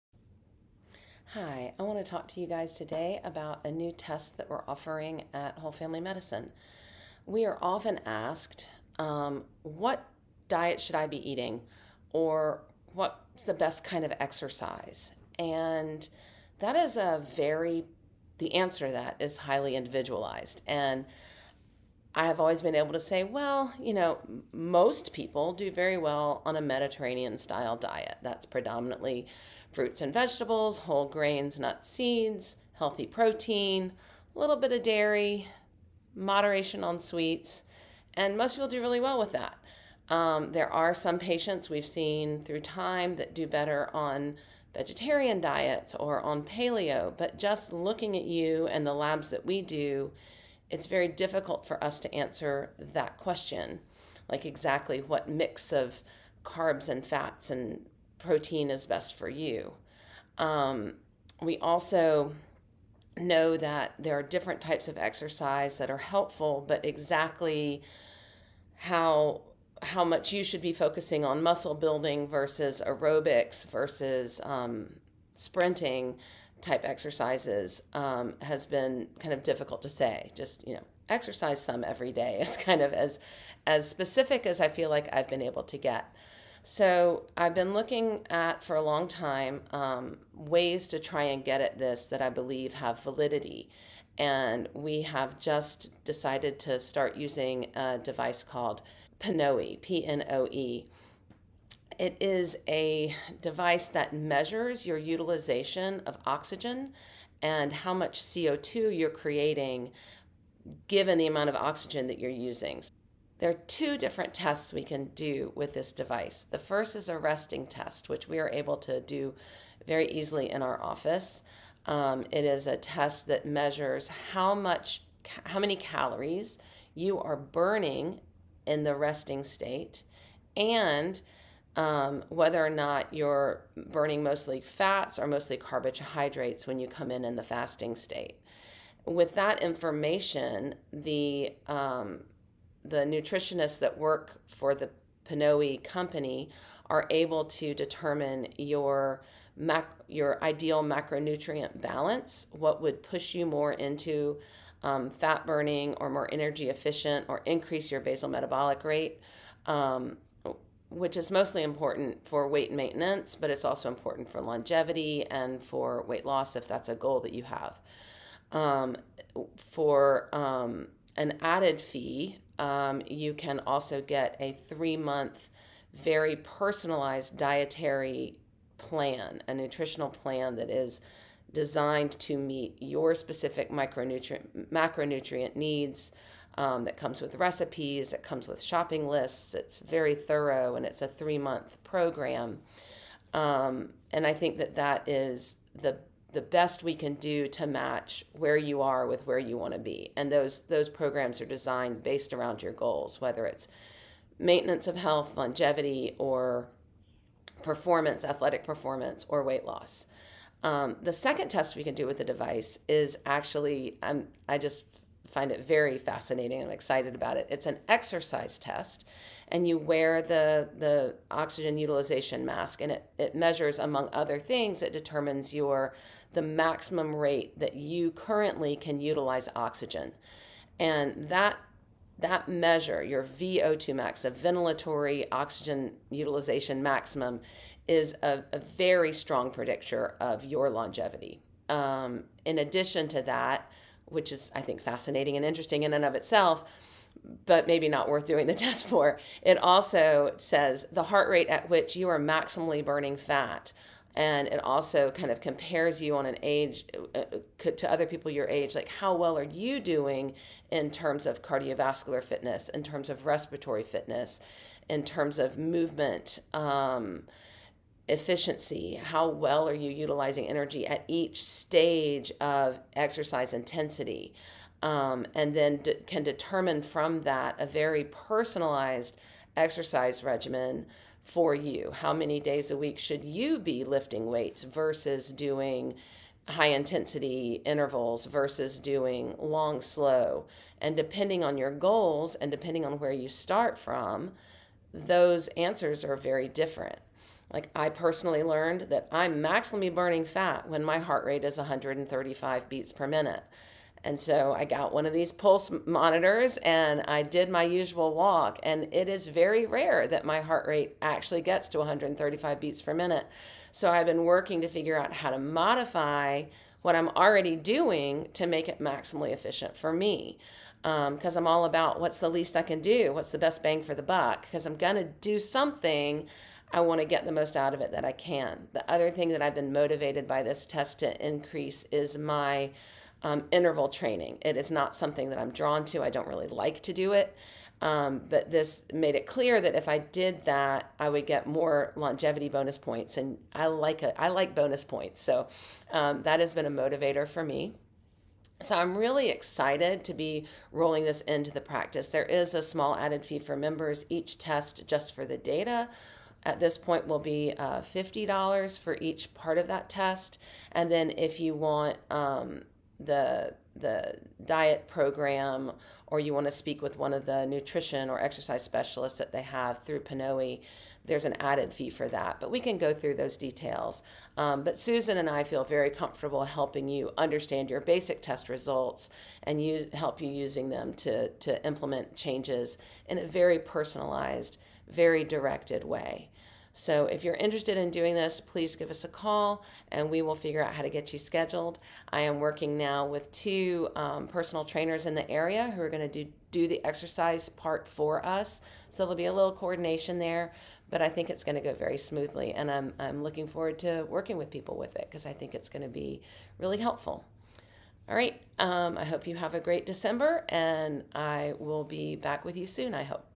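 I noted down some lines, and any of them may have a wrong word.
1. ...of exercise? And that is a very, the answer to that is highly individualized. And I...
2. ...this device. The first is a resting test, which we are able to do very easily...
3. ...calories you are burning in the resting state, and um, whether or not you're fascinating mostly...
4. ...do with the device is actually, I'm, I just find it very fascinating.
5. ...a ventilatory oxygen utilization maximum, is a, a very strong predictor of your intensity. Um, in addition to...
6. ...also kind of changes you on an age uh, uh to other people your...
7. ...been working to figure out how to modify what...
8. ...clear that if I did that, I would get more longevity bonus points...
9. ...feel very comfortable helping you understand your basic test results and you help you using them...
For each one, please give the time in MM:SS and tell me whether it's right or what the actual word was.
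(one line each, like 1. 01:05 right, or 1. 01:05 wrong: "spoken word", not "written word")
1. 00:14 right
2. 01:55 right
3. 02:05 wrong: "burning", not "fascinating"
4. 03:31 right
5. 03:54 wrong: "longevity", not "intensity"
6. 04:14 wrong: "compares", not "changes"
7. 05:14 right
8. 05:39 right
9. 06:15 right.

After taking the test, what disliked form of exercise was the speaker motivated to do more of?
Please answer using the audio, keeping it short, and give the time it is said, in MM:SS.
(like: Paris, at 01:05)
interval training, at 05:33.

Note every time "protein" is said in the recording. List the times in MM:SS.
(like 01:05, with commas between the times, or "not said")
00:33, 00:58.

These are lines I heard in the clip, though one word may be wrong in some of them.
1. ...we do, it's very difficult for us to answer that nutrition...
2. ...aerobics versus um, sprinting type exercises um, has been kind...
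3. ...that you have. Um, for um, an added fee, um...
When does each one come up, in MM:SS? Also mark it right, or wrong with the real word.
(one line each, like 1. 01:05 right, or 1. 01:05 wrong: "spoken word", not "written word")
1. 00:49 wrong: "question", not "nutrition"
2. 01:12 right
3. 02:47 right.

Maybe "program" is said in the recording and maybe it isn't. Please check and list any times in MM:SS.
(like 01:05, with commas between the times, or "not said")
03:11, 03:20, 06:04.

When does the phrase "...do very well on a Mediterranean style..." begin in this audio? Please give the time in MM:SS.
00:25.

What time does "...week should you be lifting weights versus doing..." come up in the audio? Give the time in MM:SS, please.
04:42.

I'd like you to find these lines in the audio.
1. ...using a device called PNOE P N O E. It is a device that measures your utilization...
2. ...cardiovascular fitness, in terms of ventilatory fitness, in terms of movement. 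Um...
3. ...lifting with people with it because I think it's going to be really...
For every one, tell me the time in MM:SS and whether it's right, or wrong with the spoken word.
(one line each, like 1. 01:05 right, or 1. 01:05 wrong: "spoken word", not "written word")
1. 01:37 right
2. 04:21 wrong: "respiratory", not "ventilatory"
3. 06:44 wrong: "working", not "lifting".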